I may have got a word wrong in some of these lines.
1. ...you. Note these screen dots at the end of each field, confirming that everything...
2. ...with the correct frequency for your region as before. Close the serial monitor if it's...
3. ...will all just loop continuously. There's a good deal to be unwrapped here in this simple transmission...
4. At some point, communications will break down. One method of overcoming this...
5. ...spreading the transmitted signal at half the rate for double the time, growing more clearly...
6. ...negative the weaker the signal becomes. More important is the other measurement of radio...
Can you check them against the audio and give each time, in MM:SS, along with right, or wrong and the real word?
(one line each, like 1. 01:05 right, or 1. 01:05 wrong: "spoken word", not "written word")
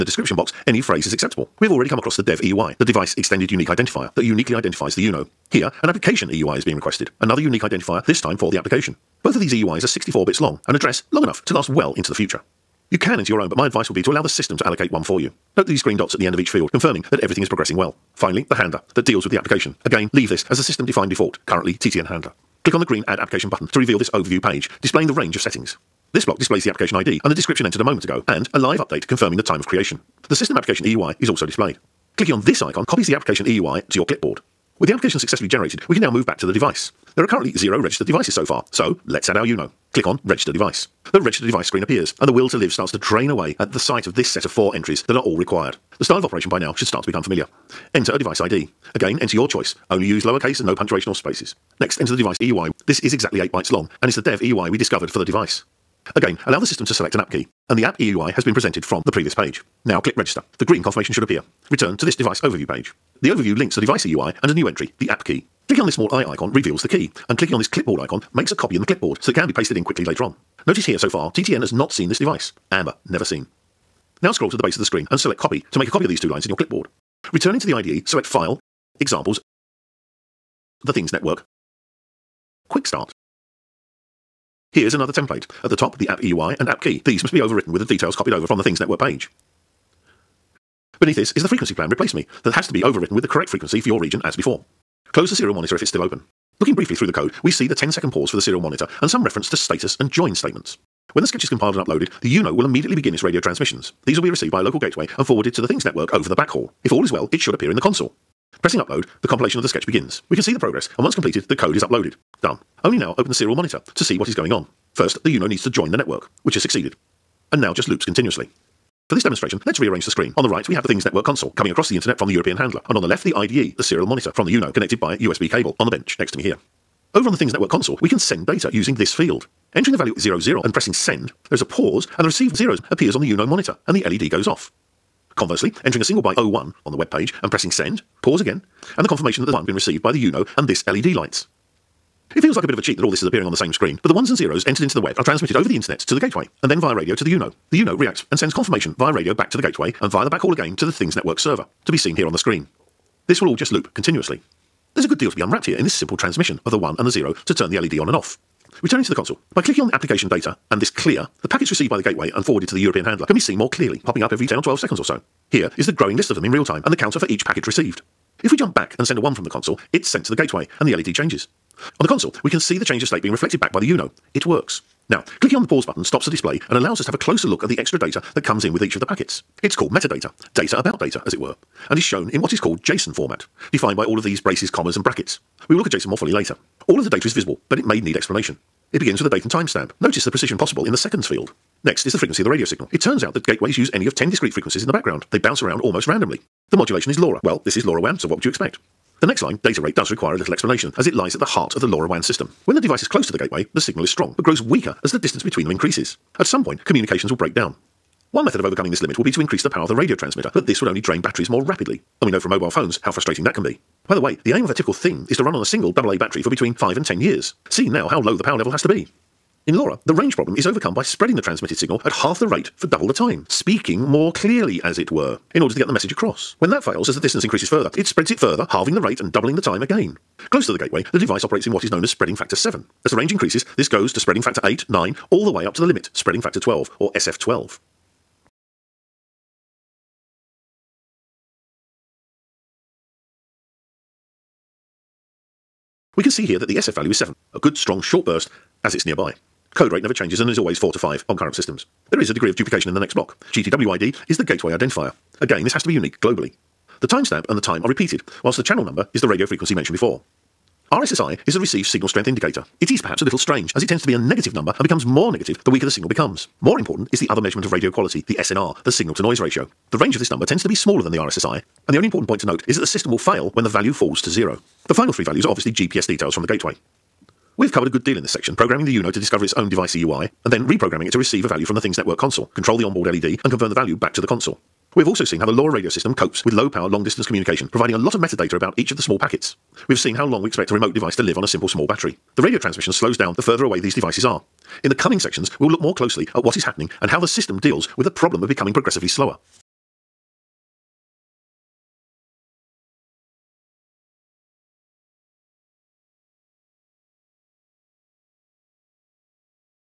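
1. 00:15 wrong: "green", not "screen"
2. 01:33 right
3. 02:33 right
4. 03:26 right
5. 03:41 wrong: "speaking", not "growing"
6. 04:25 right.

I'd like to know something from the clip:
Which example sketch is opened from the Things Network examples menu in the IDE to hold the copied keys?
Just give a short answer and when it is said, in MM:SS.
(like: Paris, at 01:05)
Quick Start, at 01:22.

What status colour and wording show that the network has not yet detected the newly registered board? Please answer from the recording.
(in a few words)
Amber, never seen.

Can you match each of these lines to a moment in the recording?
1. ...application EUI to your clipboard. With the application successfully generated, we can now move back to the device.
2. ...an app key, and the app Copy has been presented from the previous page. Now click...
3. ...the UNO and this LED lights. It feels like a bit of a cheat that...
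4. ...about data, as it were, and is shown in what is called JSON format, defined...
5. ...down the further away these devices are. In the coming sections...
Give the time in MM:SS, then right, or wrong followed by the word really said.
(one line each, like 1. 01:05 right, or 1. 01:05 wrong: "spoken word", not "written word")
1. 00:33 right
2. 00:57 wrong: "EUI", not "Copy"
3. 02:20 right
4. 03:00 right
5. 04:53 right.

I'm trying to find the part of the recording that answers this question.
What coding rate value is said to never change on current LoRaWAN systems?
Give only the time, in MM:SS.
04:10.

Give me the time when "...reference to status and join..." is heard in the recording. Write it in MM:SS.
01:39.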